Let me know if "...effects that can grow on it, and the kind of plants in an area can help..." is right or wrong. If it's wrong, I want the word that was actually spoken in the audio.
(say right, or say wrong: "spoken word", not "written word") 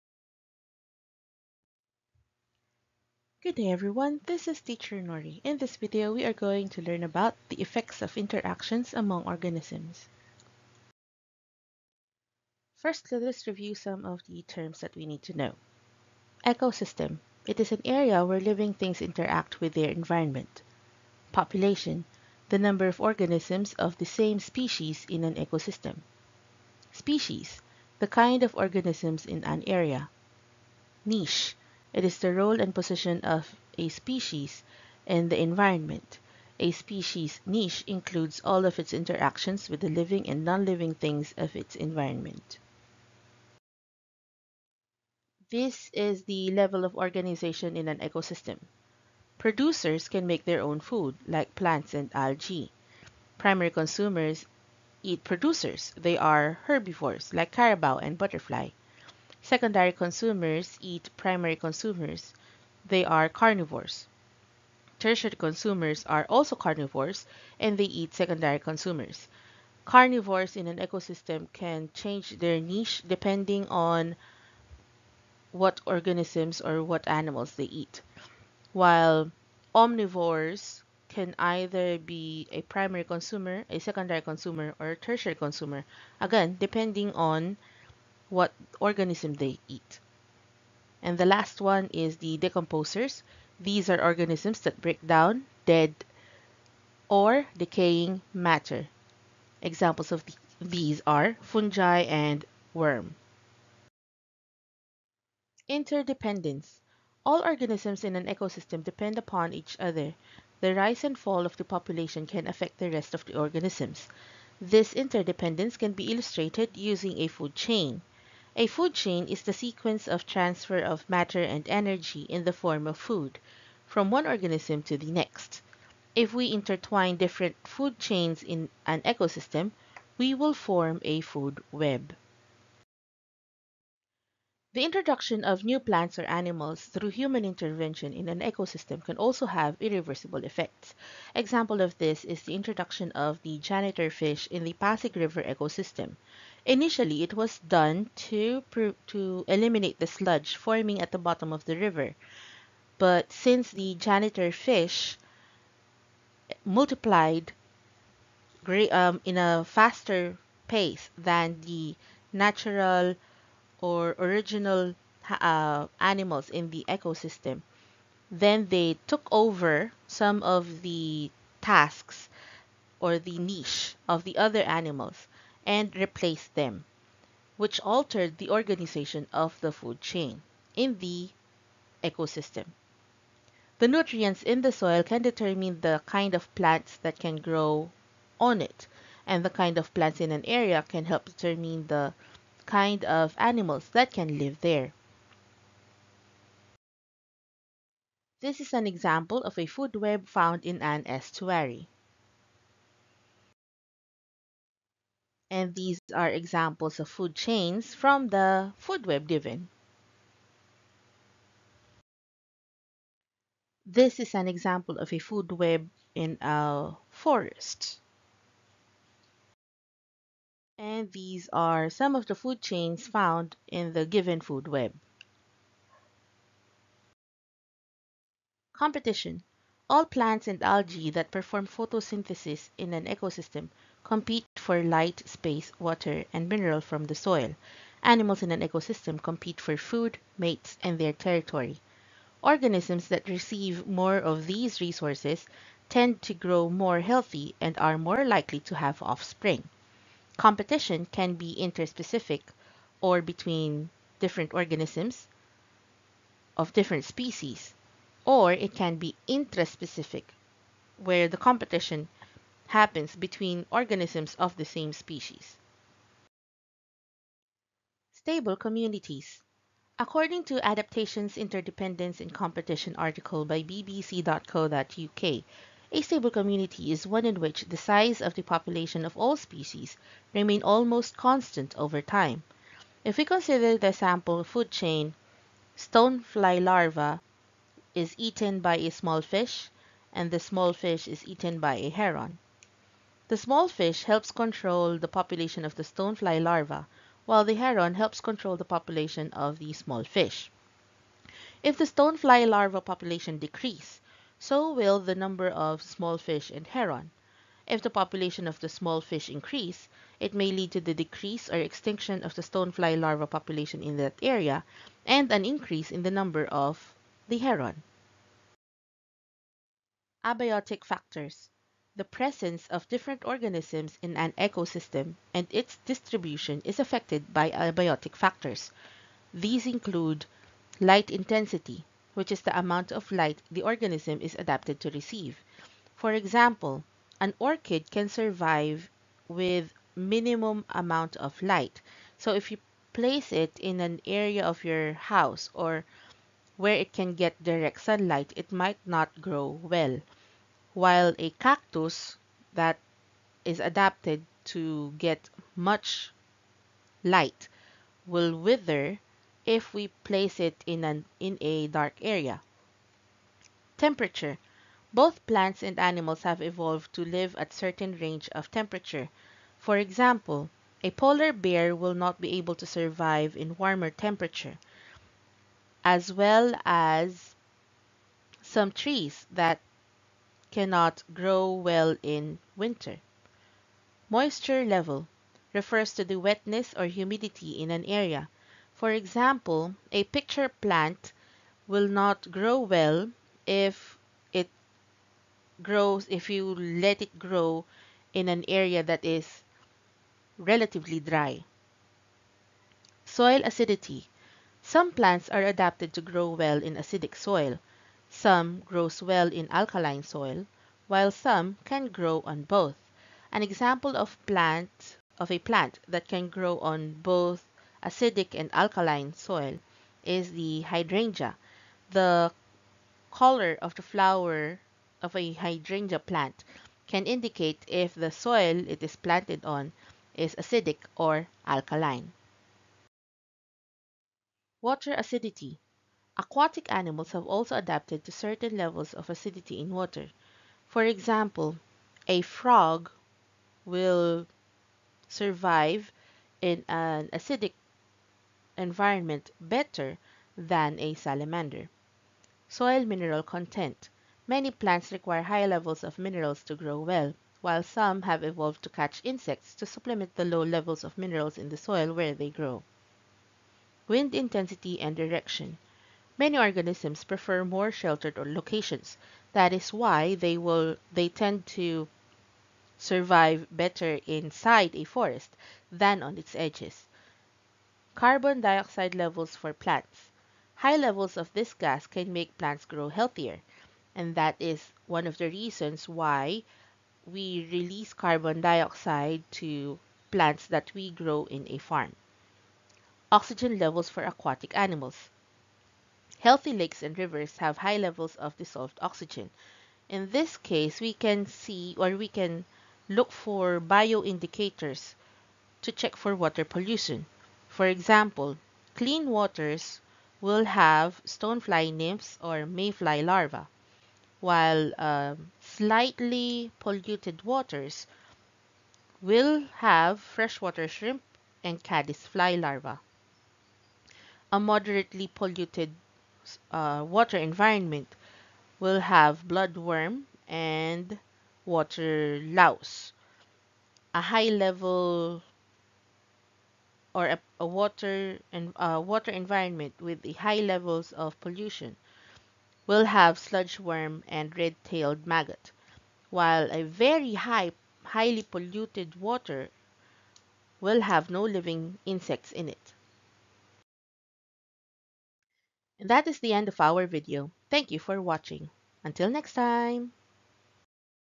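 wrong: "plants", not "effects".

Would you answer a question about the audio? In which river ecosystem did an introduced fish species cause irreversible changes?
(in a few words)
Pasig River.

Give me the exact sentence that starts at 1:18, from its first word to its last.
While omnivores can either be a primary consumer, a secondary consumer, or a tertiary consumer.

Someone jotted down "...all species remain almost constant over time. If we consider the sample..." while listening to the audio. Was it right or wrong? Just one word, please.
right.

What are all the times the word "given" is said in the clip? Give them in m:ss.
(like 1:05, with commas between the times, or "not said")
3:29, 3:44.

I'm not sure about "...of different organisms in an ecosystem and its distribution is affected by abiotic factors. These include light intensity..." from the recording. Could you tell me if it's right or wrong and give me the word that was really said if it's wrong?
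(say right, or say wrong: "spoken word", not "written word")
right.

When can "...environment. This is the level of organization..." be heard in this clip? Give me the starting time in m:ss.
0:41.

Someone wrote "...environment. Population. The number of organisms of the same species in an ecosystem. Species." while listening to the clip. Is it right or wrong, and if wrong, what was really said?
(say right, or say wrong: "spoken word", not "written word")
right.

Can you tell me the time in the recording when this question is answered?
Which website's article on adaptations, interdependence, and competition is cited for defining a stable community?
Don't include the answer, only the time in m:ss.
4:33.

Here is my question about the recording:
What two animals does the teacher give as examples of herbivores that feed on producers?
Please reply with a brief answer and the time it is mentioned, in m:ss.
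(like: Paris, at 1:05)
carabao and butterfly, at 0:57.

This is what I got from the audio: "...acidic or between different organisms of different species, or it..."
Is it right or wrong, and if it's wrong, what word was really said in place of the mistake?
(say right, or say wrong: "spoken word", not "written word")
wrong: "interspecific", not "acidic".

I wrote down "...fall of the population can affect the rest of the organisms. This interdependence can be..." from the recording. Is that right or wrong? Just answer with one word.
right.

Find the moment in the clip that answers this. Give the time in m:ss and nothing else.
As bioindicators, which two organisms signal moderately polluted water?
8:49.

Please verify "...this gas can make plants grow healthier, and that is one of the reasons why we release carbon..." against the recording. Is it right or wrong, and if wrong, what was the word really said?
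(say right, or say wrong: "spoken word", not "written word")
right.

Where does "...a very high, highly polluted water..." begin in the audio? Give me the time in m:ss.
9:06.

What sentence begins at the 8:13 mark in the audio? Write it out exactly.
Oxygen levels for aquatic animals healthy lakes and rivers have high levels of dissolved oxygen.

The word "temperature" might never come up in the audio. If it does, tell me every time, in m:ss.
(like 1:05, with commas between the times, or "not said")
6:03, 6:08, 6:13.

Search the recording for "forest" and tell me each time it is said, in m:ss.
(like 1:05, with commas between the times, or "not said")
3:37, 7:54.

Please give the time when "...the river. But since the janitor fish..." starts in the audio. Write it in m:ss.
2:31.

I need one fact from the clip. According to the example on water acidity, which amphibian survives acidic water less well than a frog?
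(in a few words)
salamander.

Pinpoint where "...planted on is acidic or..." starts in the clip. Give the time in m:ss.
7:08.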